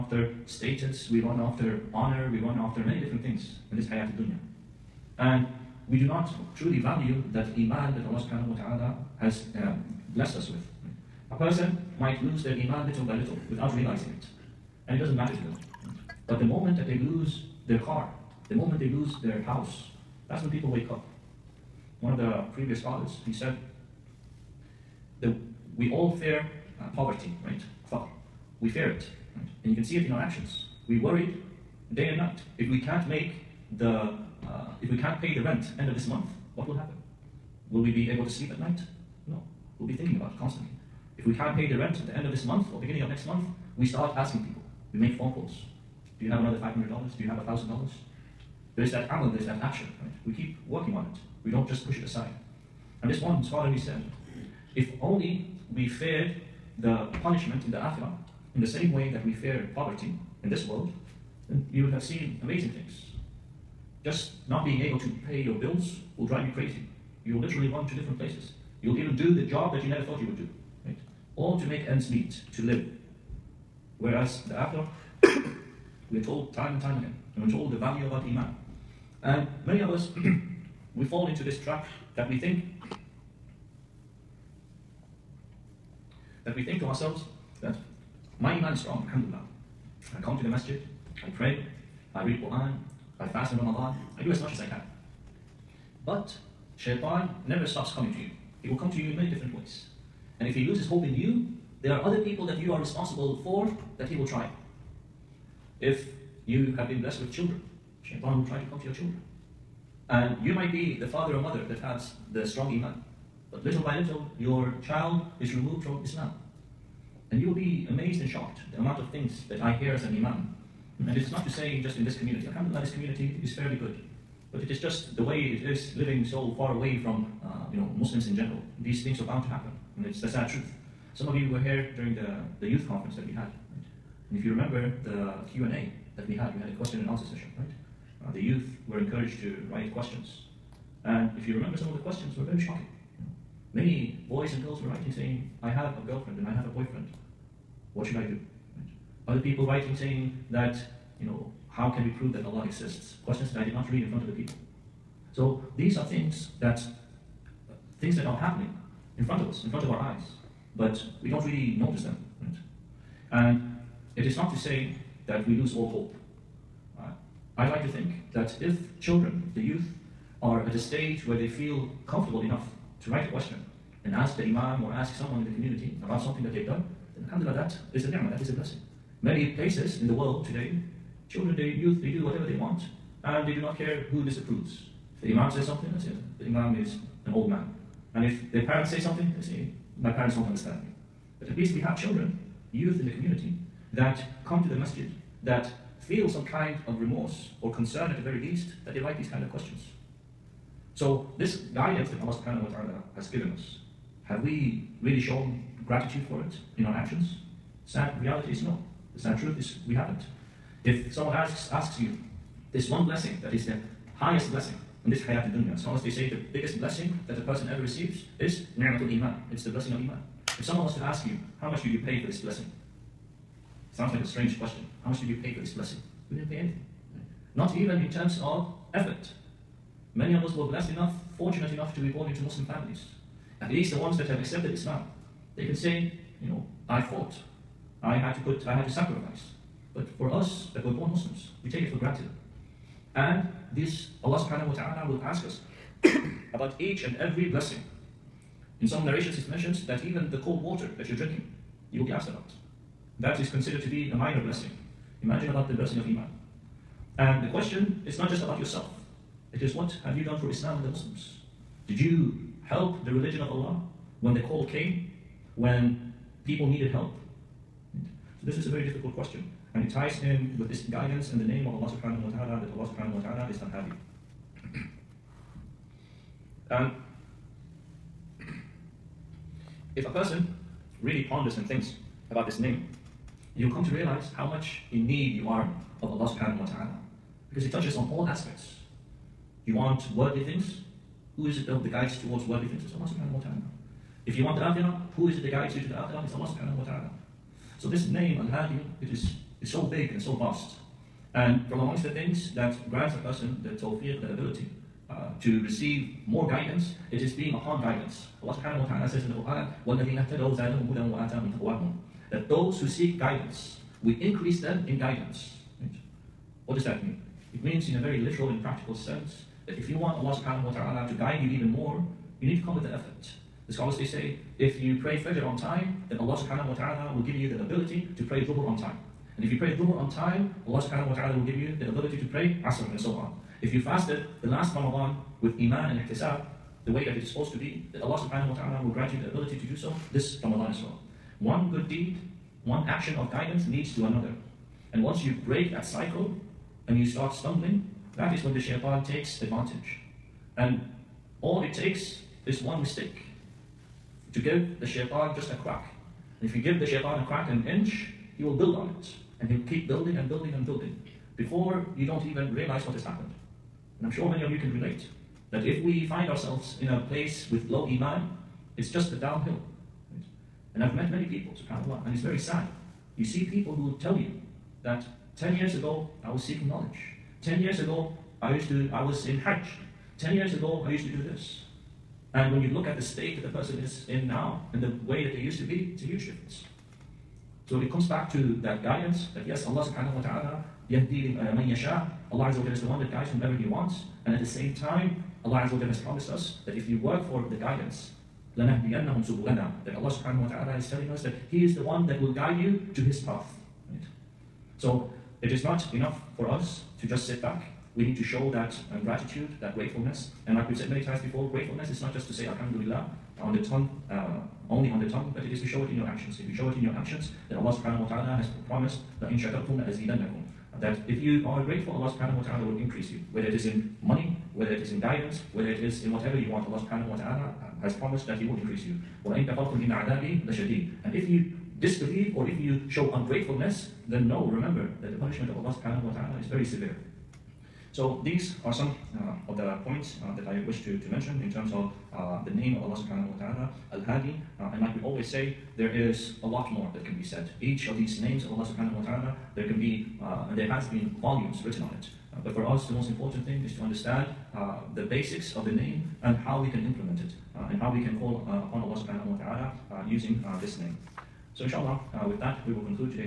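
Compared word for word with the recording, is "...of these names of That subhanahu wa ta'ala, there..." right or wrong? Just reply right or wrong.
wrong.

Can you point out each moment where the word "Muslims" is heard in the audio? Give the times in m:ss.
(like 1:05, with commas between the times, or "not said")
2:07, 3:52, 4:01, 4:20.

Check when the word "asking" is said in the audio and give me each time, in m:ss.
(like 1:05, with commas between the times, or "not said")
0:44.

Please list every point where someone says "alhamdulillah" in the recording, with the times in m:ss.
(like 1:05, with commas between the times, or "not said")
1:29, 2:02, 2:57, 6:52.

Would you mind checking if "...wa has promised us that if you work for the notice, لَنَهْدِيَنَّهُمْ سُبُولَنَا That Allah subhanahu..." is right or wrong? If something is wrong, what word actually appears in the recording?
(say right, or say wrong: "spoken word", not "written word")
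wrong: "guidance", not "notice".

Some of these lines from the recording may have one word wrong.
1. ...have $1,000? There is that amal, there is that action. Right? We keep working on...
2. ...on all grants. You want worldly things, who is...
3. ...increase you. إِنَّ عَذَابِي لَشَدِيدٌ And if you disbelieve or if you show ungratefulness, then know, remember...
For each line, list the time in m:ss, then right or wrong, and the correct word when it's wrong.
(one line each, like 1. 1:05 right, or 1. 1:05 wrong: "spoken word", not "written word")
1. 0:47 right
2. 4:47 wrong: "aspects", not "grants"
3. 7:08 right.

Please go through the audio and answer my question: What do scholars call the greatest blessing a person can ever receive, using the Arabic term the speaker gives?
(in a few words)
Ni'matul iman.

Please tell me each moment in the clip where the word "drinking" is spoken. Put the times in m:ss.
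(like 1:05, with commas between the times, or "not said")
4:11.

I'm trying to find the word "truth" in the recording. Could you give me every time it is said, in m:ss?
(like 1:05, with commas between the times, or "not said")
2:10, 3:29.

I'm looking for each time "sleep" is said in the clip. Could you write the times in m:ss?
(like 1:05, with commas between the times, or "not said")
0:38.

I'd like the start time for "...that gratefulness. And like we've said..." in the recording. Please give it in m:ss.
6:49.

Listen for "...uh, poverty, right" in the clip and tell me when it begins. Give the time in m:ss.
0:26.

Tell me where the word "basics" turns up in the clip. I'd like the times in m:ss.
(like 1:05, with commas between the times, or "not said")
7:35.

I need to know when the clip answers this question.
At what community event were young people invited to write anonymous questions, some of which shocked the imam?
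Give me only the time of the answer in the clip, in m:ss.
2:12.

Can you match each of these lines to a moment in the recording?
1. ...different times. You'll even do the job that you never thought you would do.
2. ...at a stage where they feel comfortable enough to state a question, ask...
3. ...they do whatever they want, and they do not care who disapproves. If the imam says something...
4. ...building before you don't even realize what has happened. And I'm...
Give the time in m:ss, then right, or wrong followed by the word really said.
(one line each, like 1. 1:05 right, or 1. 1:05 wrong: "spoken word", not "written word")
1. 1:07 wrong: "places", not "times"
2. 2:50 wrong: "write", not "state"
3. 3:02 right
4. 6:00 right.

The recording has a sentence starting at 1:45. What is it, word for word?
If you have been blessed with children, Shaitan will try to come to your children.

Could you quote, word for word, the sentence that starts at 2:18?
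Uh, the youth were encouraged to write questions and if you remember, some of the questions were very shocking.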